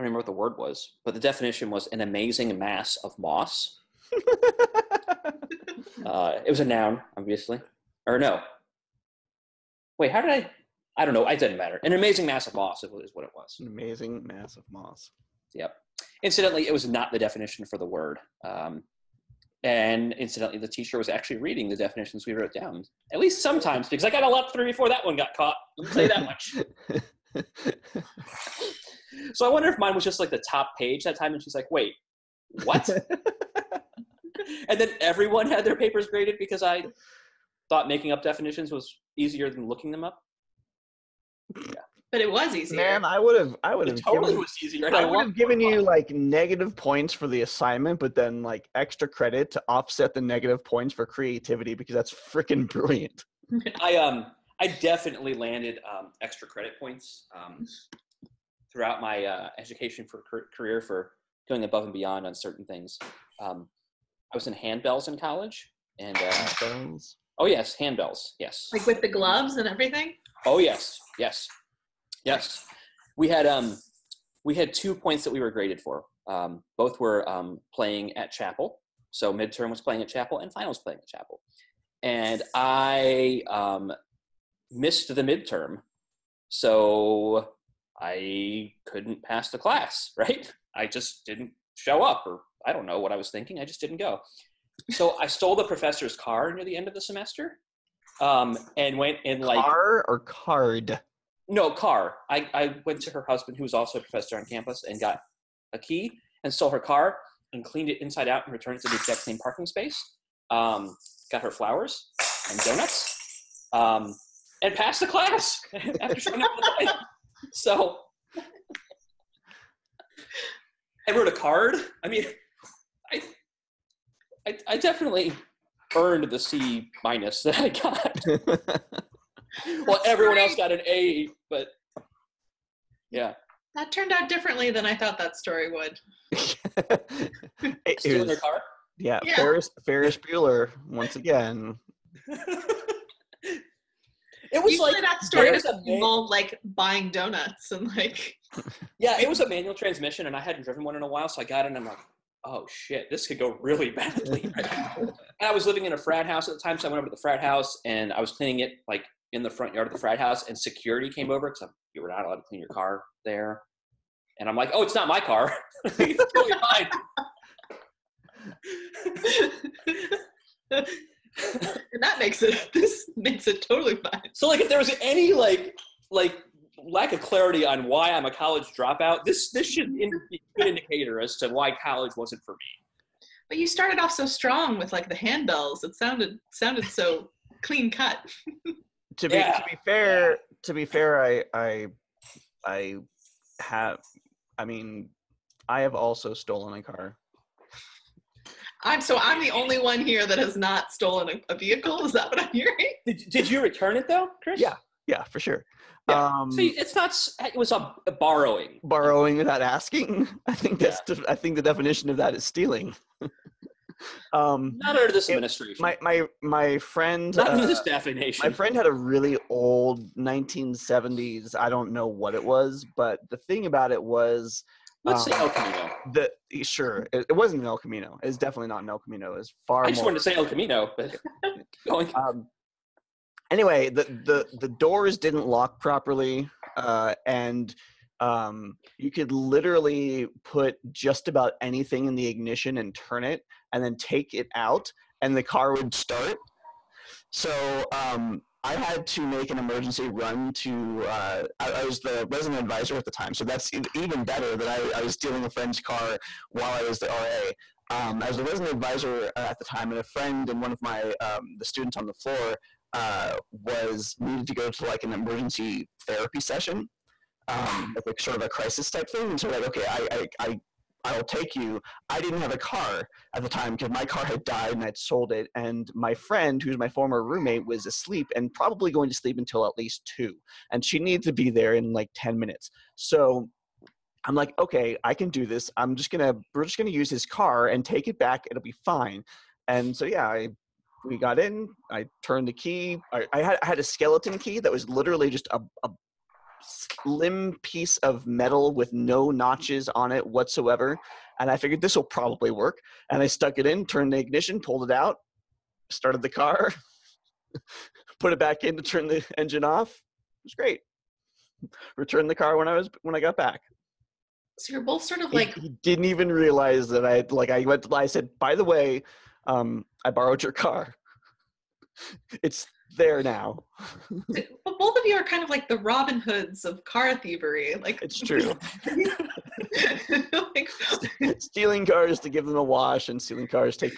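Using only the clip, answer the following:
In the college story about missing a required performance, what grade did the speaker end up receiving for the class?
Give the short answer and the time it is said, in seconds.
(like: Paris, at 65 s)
C minus, at 126 s.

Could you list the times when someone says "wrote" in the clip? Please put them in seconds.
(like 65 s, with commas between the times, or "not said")
22 s, 121 s.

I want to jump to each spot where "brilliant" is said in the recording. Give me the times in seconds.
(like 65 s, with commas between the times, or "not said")
52 s.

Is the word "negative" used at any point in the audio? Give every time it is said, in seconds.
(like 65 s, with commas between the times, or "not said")
46 s, 50 s.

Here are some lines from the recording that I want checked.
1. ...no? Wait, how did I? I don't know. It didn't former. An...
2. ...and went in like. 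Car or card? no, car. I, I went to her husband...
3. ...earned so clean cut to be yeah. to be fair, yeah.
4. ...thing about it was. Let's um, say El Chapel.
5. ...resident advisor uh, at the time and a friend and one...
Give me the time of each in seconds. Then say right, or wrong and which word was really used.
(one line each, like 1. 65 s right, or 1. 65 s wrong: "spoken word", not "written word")
1. 8 s wrong: "matter", not "former"
2. 98 s right
3. 186 s wrong: "sounded", not "earned"
4. 223 s wrong: "Camino", not "Chapel"
5. 258 s right.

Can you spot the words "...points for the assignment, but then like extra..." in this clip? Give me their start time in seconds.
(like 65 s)
46 s.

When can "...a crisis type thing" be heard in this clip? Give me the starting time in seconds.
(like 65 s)
268 s.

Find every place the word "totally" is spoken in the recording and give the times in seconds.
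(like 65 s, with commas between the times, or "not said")
44 s, 166 s, 173 s.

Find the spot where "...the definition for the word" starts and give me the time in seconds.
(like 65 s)
17 s.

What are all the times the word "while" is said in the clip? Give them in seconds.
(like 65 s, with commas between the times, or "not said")
151 s, 256 s.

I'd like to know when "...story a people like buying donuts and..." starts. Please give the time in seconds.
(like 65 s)
145 s.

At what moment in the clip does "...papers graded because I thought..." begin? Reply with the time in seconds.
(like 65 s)
35 s.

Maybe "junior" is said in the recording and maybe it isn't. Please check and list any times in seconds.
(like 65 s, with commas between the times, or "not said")
not said.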